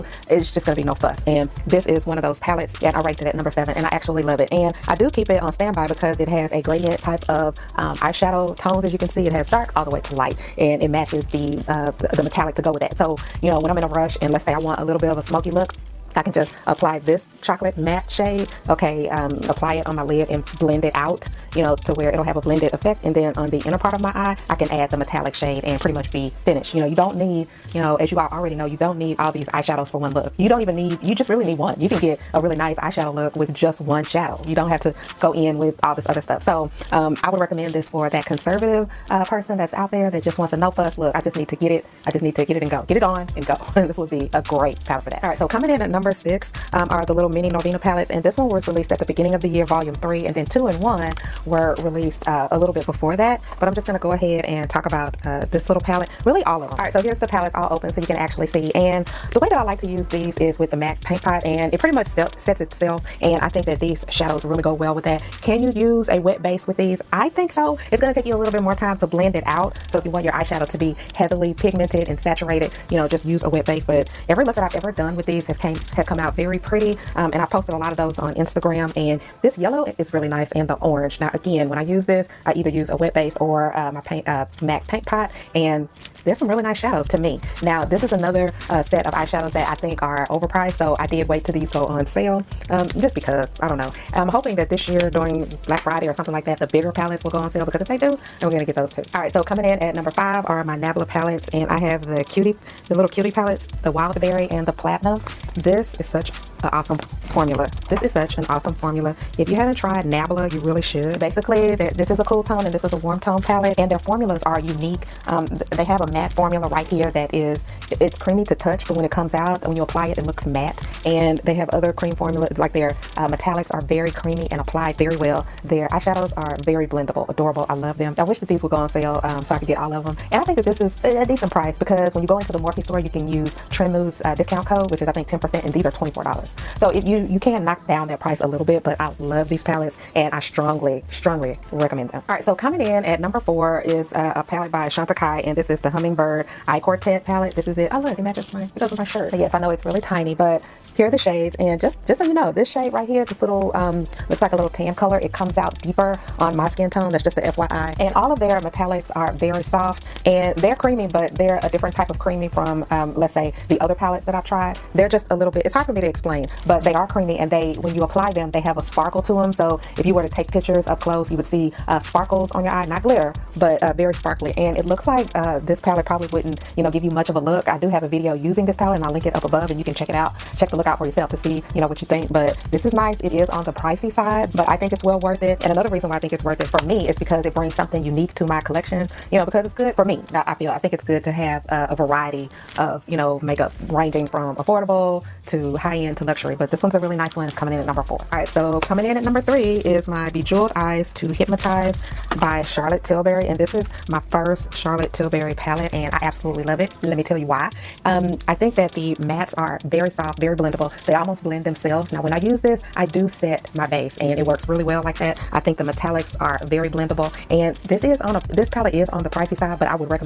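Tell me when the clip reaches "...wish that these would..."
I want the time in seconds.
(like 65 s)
128 s.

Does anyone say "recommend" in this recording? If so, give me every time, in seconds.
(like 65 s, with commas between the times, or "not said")
37 s, 141 s.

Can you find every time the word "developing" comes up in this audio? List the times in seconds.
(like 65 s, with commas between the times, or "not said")
not said.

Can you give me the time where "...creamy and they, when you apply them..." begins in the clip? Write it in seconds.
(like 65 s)
167 s.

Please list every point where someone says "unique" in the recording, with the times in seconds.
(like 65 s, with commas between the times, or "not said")
114 s, 188 s.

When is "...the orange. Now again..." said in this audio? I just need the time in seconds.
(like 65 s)
80 s.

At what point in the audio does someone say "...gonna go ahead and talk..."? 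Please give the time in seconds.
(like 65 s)
53 s.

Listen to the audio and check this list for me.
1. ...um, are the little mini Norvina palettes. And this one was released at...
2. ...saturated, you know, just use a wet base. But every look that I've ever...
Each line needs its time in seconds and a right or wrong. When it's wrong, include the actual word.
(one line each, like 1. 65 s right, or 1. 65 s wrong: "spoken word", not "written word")
1. 46 s right
2. 72 s right.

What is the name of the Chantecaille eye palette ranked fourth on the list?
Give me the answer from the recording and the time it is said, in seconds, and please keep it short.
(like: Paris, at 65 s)
Hummingbird Eye Quartet, at 145 s.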